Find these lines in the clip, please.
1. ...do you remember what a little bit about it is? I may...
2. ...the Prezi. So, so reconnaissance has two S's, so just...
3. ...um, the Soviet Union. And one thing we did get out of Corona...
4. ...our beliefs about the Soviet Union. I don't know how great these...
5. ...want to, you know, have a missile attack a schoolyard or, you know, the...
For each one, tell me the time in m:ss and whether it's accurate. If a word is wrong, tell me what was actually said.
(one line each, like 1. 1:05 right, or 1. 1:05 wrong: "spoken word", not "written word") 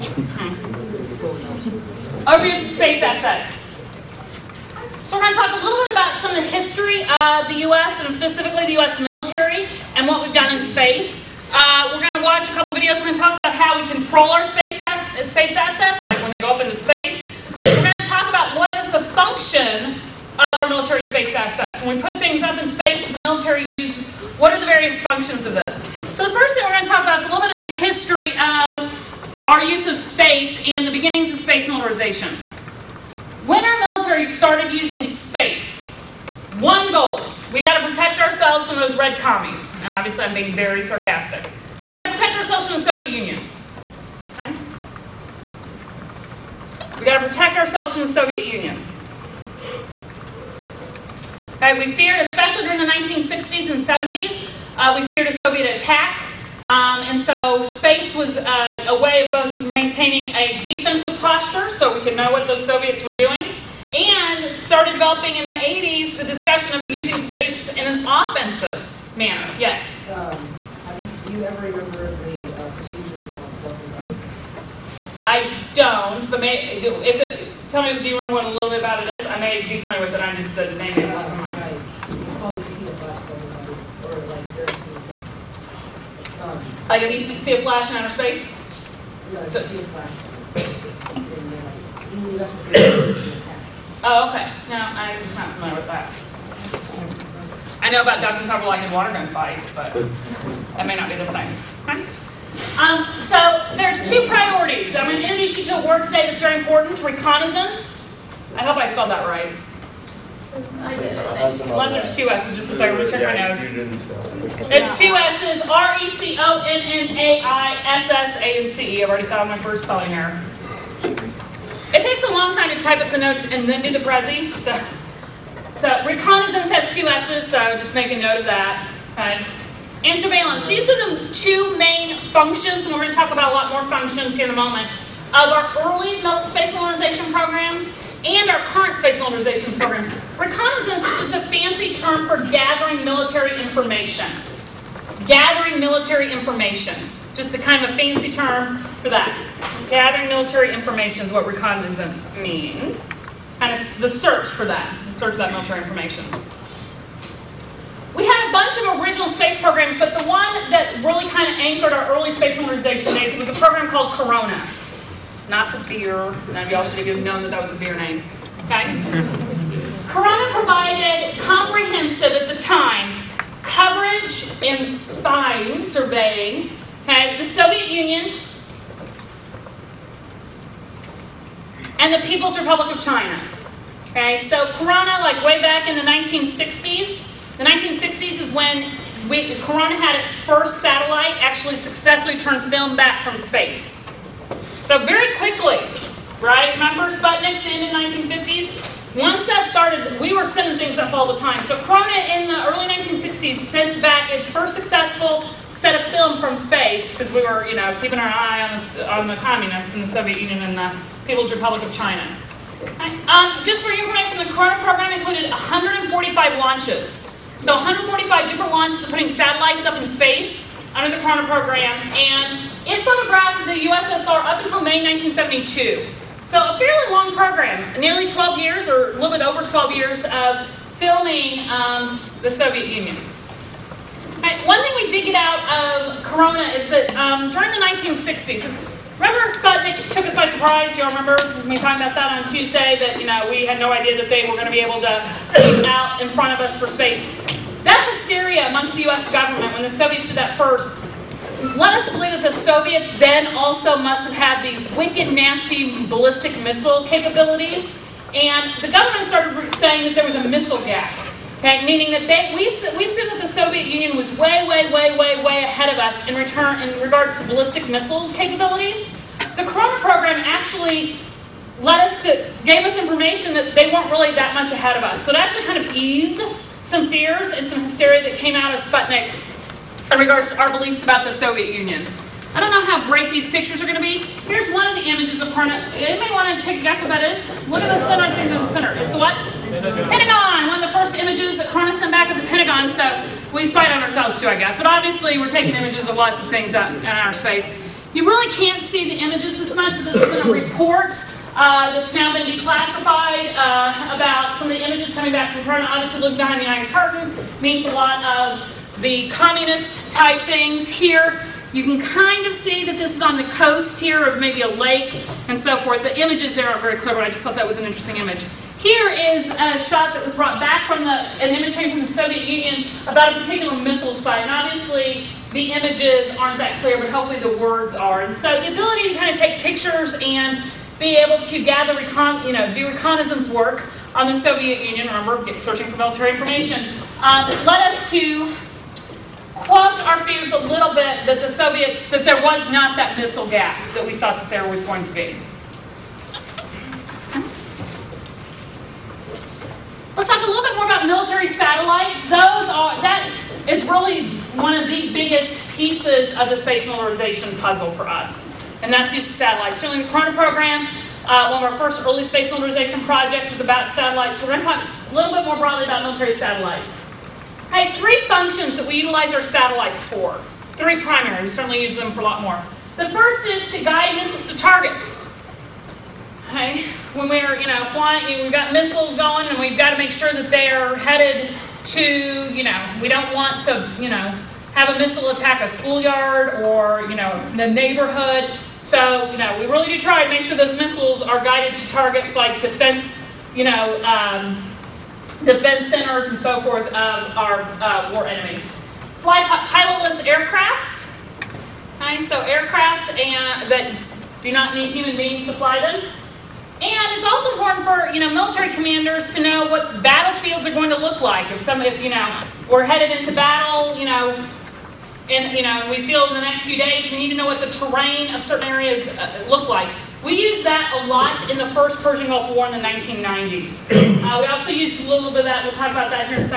1. 1:17 right
2. 2:03 right
3. 3:51 right
4. 4:40 right
5. 6:23 right.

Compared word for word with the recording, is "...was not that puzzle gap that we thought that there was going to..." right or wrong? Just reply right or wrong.
wrong.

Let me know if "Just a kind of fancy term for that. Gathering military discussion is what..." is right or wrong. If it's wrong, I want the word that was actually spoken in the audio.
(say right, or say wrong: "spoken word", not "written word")
wrong: "information", not "discussion".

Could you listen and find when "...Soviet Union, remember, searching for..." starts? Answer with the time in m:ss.
5:34.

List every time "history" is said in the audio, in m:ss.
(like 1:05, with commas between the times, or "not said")
0:06, 0:27.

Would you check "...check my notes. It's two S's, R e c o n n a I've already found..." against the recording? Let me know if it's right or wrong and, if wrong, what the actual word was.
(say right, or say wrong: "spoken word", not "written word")
right.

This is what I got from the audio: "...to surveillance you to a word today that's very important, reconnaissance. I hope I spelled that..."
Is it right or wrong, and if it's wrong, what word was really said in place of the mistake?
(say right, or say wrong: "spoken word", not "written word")
wrong: "introduce", not "surveillance".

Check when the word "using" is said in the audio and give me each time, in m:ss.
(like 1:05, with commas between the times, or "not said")
0:34, 1:06.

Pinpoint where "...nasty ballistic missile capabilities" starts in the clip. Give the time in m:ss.
4:15.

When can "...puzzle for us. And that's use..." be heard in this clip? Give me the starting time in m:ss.
5:57.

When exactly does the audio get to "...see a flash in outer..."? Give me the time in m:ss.
1:27.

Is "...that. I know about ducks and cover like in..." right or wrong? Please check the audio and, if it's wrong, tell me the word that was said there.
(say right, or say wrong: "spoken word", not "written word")
right.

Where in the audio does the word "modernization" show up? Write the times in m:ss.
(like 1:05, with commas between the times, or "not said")
2:42.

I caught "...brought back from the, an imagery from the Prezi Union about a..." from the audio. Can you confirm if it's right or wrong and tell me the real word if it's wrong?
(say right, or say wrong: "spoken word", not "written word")
wrong: "Soviet", not "Prezi".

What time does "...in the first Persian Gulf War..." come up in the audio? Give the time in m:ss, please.
7:01.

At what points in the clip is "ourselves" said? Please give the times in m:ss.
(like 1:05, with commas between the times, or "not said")
0:38, 0:42, 0:47, 4:53.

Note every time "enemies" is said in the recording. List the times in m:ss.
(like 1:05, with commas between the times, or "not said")
6:38.